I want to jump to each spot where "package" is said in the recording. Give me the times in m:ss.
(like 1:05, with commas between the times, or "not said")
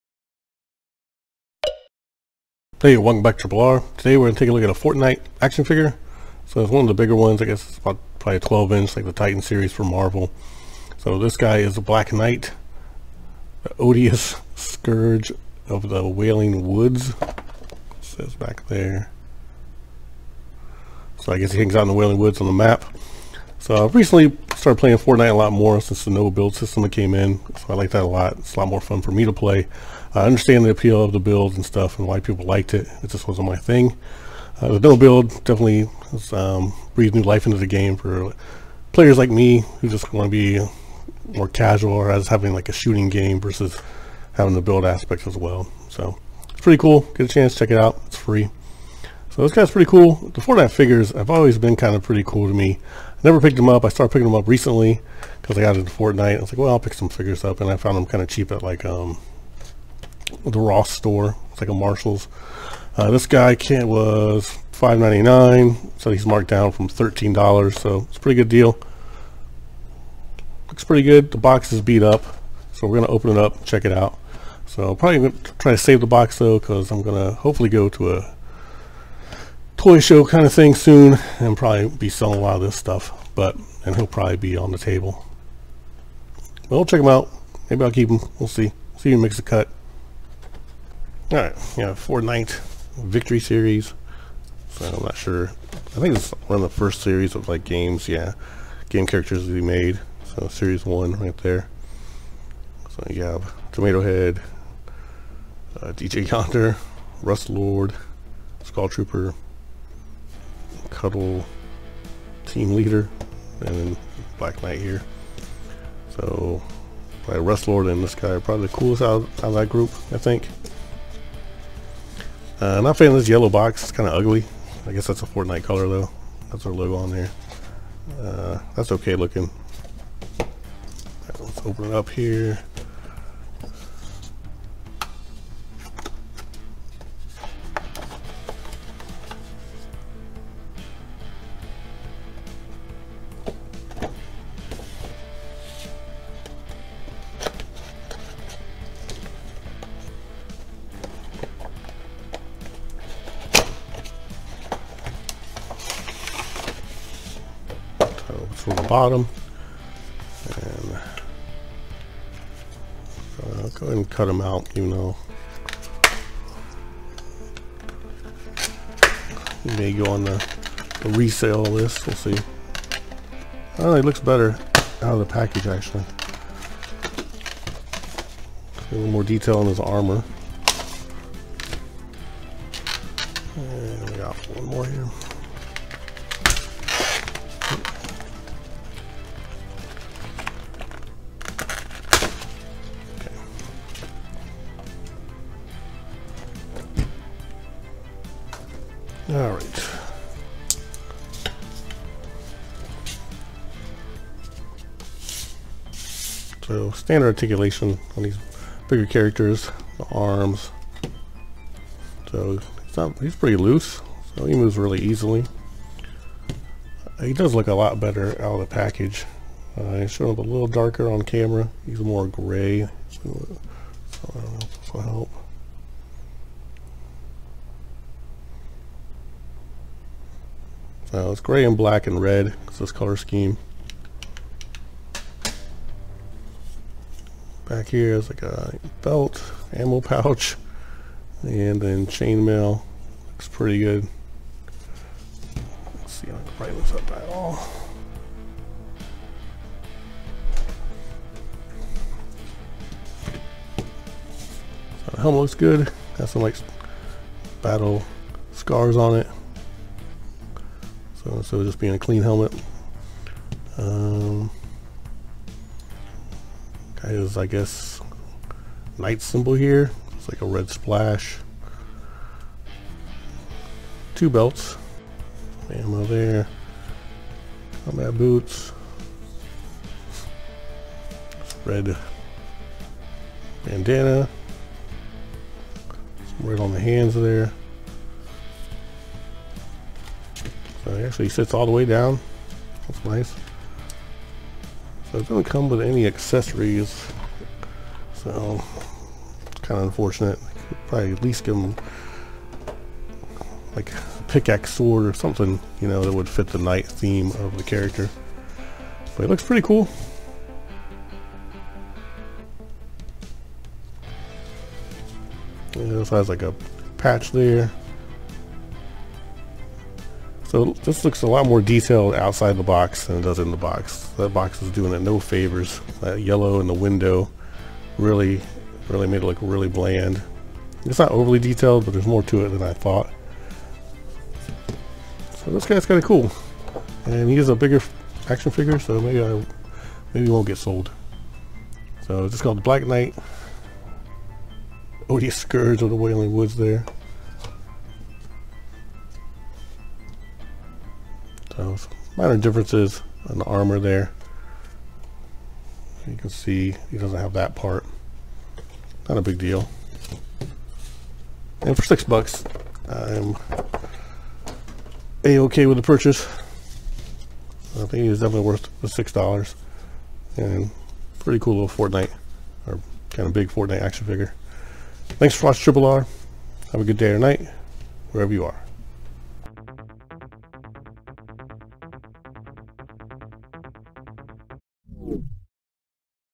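2:55, 3:38.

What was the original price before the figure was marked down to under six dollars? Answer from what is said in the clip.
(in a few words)
$13.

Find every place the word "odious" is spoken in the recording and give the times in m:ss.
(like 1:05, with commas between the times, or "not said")
0:13, 5:45.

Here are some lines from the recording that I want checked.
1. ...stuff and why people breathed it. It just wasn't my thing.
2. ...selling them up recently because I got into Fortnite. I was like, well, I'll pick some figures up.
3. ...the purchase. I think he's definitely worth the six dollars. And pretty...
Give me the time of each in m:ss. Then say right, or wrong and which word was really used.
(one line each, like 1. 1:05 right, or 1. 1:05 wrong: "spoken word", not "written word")
1. 0:31 wrong: "liked", not "breathed"
2. 0:54 wrong: "picking", not "selling"
3. 6:05 right.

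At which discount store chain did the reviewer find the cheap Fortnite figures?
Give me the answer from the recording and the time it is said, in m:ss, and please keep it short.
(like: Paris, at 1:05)
Ross, at 1:00.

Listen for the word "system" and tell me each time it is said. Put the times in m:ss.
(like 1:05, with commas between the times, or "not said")
0:26.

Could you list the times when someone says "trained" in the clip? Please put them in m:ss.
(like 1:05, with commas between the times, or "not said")
not said.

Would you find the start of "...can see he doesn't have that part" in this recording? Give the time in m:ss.
5:56.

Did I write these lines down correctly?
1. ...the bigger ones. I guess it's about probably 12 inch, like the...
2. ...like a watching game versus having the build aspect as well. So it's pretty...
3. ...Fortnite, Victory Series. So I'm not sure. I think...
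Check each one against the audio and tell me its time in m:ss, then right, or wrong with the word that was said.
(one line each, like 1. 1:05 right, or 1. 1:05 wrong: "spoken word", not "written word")
1. 0:06 right
2. 0:42 wrong: "shooting", not "watching"
3. 1:31 right.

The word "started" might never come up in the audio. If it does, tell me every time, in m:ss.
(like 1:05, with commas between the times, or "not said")
0:24, 0:53.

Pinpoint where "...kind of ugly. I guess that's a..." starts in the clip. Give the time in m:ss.
2:03.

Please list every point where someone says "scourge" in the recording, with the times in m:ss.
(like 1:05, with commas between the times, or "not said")
0:14, 5:45.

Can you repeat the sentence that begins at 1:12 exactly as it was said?
So we're going to open it up check it out.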